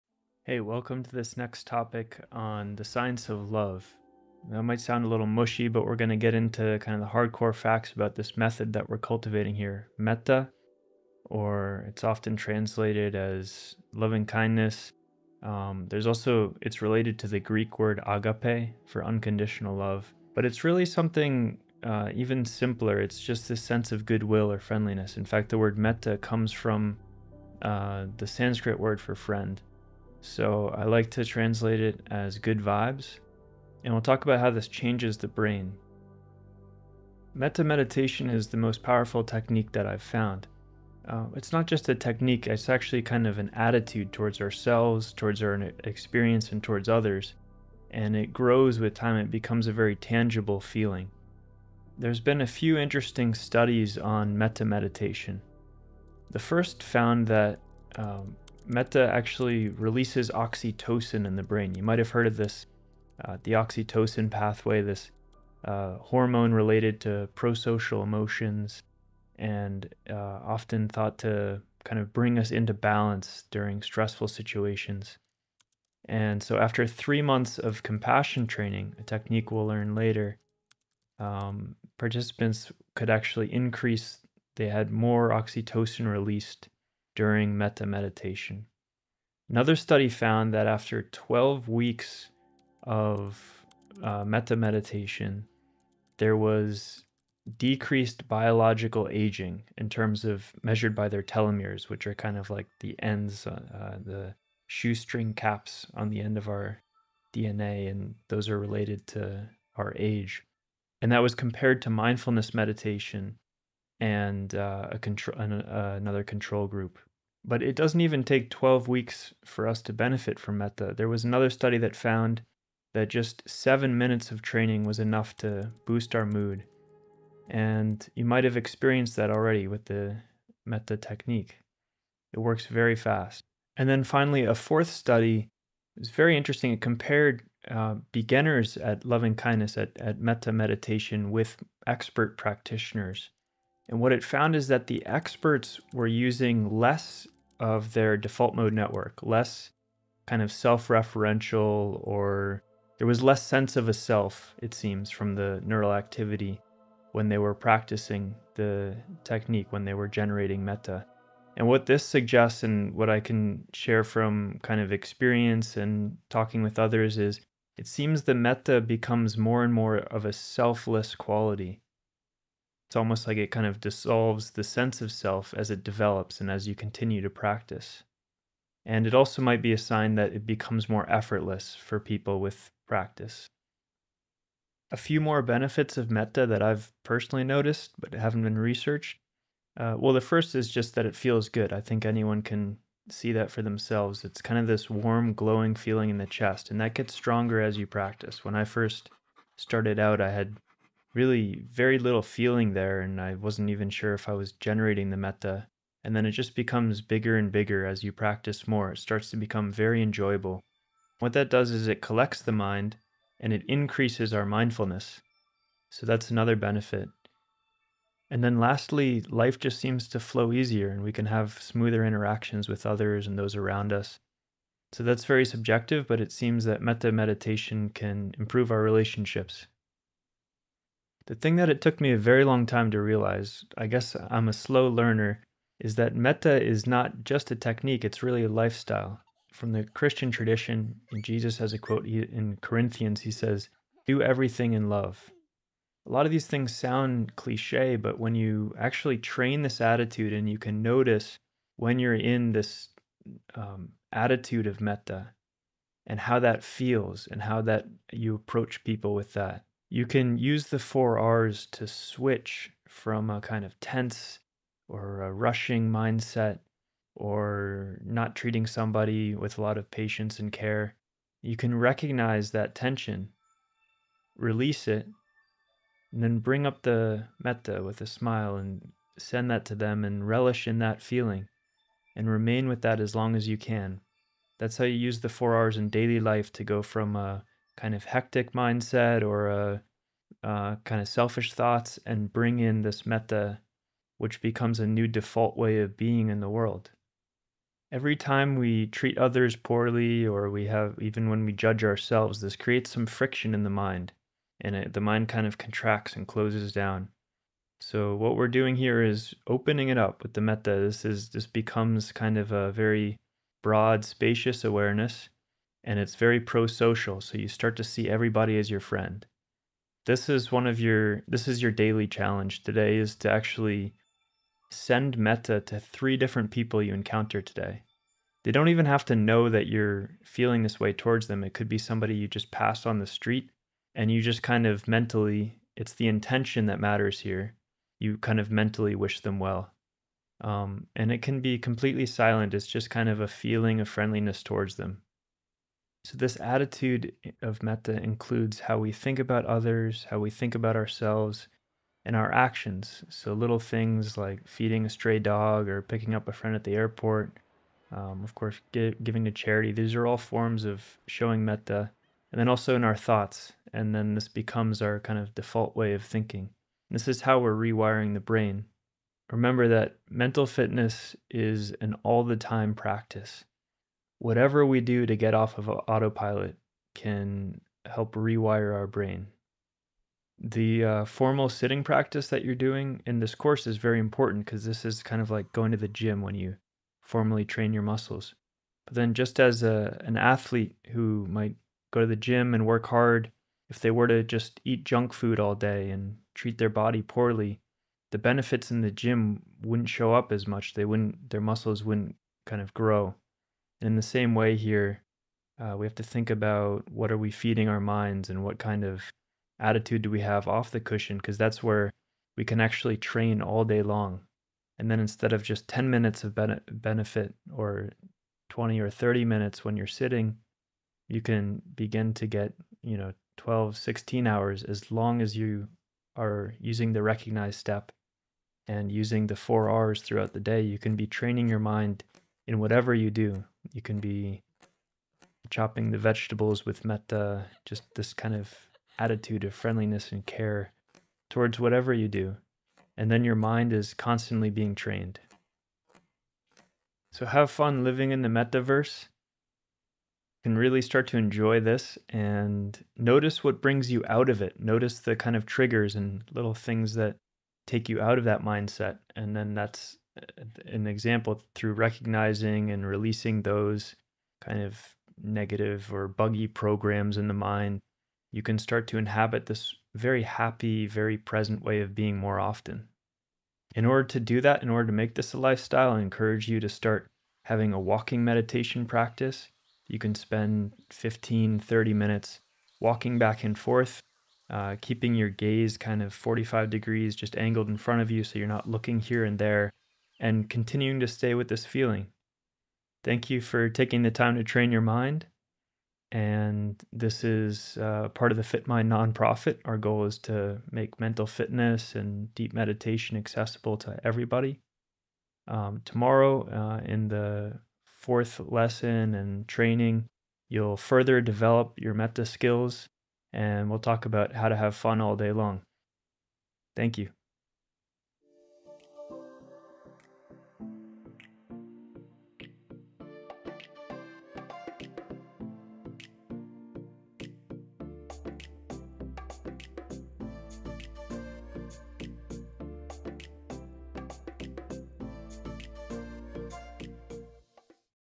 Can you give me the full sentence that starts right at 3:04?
A few more benefits of metta that I've personally noticed but haven't been researched.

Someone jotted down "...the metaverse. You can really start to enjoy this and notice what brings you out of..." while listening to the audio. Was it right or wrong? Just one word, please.
right.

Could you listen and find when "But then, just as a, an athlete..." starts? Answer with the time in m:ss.
6:28.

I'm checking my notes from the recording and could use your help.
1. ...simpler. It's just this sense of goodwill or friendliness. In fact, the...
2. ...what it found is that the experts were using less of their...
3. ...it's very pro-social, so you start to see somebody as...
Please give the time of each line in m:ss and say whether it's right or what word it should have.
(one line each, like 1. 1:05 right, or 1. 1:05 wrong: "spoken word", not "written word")
1. 0:22 right
2. 2:23 right
3. 5:15 wrong: "everybody", not "somebody".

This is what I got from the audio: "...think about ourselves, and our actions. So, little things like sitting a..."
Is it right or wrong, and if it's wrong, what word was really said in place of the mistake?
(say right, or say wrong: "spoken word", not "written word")
wrong: "feeding", not "sitting".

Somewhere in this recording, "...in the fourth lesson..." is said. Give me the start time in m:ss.
8:26.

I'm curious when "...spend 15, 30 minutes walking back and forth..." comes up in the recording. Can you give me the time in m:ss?
8:00.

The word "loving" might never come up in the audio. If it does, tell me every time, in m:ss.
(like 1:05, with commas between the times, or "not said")
0:13, 2:19.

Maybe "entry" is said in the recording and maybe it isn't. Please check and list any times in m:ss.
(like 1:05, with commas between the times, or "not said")
not said.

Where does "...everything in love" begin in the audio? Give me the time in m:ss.
4:04.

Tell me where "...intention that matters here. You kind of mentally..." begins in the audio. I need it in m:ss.
5:36.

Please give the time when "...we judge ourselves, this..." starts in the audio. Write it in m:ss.
5:01.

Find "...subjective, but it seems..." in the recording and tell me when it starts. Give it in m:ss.
3:45.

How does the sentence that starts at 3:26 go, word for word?
And then it just becomes bigger and bigger as you practice more.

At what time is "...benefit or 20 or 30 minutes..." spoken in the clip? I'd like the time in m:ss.
6:56.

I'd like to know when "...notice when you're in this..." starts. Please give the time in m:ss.
4:10.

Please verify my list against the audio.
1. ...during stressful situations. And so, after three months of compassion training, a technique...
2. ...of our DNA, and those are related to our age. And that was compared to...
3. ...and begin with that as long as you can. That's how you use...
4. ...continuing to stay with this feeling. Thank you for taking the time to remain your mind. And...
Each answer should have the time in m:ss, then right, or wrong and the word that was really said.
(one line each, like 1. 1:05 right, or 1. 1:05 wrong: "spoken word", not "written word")
1. 1:13 right
2. 1:46 right
3. 4:42 wrong: "remain", not "begin"
4. 8:10 wrong: "train", not "remain".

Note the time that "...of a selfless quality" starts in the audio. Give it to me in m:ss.
2:49.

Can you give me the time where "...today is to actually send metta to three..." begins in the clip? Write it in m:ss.
5:22.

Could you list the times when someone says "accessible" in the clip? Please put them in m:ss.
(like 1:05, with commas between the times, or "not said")
8:23.